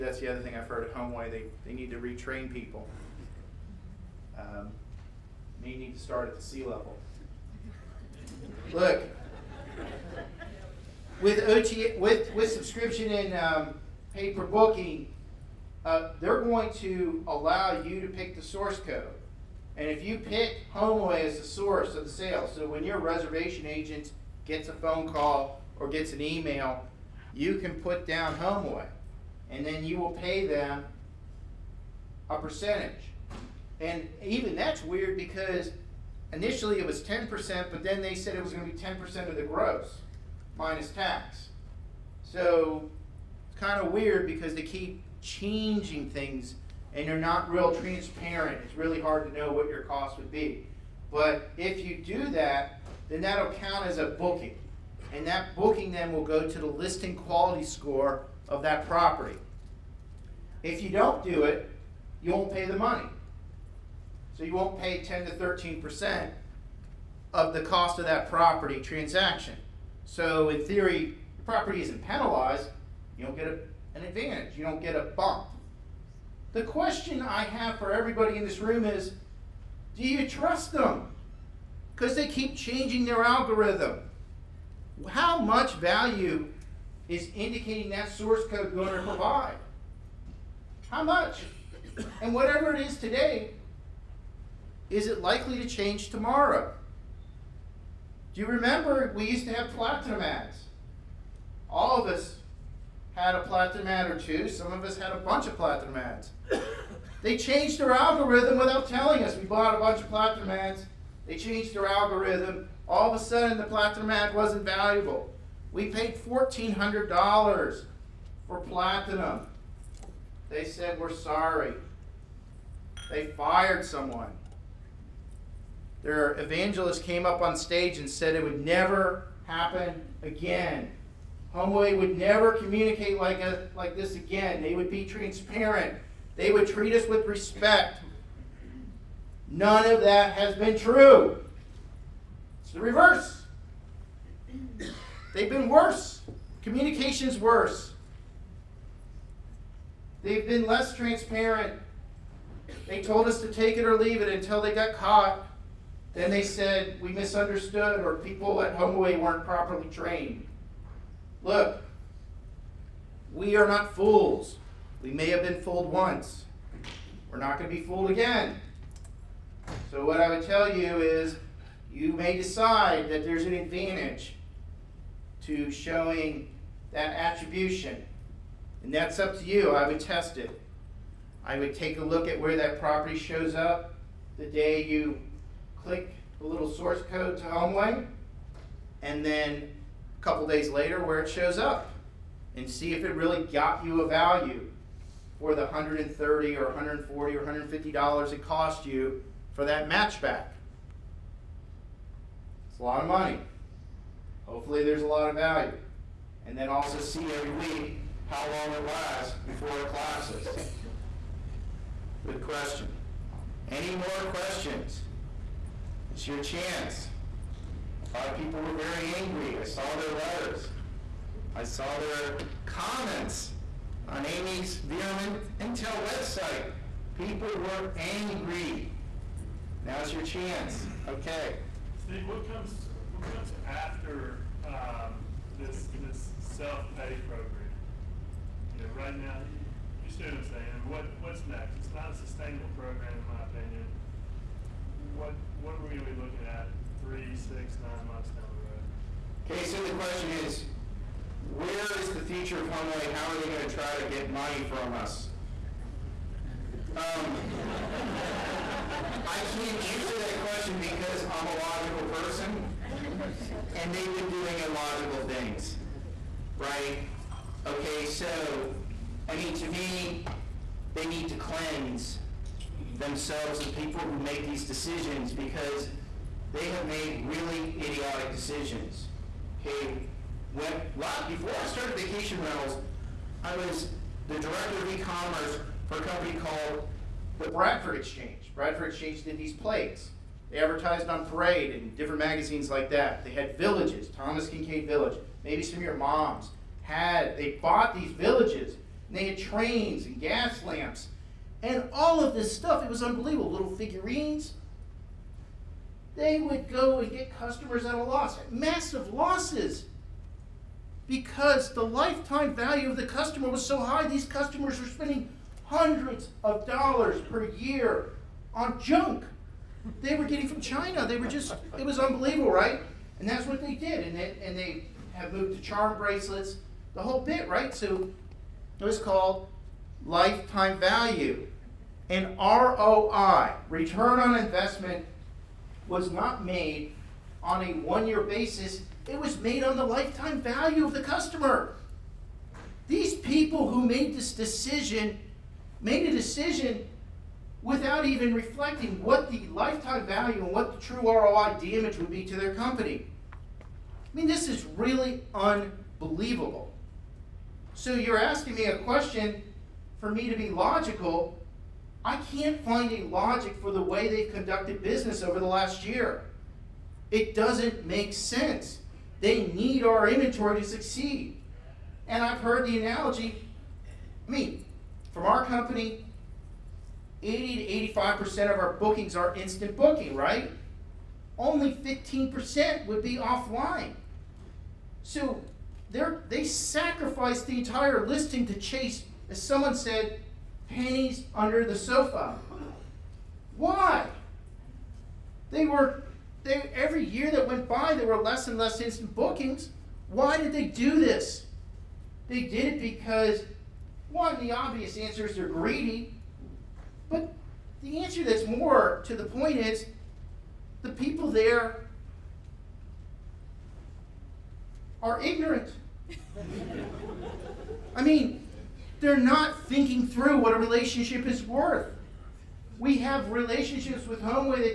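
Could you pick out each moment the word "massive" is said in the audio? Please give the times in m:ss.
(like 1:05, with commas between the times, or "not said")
5:08.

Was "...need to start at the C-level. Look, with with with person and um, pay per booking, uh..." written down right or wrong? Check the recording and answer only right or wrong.
wrong.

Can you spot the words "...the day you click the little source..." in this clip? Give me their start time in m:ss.
3:04.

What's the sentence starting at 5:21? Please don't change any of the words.
They were just, it was unbelievable, right?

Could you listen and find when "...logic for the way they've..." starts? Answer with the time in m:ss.
6:03.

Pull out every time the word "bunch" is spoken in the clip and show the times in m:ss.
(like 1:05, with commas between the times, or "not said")
1:45, 1:49.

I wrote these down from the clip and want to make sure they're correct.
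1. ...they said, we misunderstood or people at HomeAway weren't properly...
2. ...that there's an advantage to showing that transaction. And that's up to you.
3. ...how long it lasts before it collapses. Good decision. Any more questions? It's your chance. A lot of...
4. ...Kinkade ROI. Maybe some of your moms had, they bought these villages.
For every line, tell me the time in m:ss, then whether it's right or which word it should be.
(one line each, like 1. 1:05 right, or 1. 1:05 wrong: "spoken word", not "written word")
1. 2:36 right
2. 2:53 wrong: "attribution", not "transaction"
3. 3:28 wrong: "question", not "decision"
4. 4:54 wrong: "Village", not "ROI".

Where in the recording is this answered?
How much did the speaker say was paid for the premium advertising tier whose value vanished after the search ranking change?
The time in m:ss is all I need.
1:56.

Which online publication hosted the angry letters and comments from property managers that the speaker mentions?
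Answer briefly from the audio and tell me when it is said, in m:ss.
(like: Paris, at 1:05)
VRM Intel, at 3:44.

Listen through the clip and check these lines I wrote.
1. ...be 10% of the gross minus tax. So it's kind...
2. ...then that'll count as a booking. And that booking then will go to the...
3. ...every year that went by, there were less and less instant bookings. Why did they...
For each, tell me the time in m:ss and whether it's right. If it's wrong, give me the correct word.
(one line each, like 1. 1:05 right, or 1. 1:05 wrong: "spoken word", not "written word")
1. 0:38 right
2. 0:53 right
3. 6:36 right.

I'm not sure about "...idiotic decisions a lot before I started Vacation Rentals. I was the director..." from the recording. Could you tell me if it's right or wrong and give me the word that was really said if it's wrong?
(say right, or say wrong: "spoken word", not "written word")
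right.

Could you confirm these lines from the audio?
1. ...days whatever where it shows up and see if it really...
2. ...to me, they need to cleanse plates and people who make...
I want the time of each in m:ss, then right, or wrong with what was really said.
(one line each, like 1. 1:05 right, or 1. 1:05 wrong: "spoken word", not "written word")
1. 3:10 wrong: "later", not "whatever"
2. 4:29 wrong: "themselves", not "plates".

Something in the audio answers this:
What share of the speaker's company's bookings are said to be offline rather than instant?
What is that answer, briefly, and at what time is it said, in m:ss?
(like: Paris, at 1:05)
15%, at 6:21.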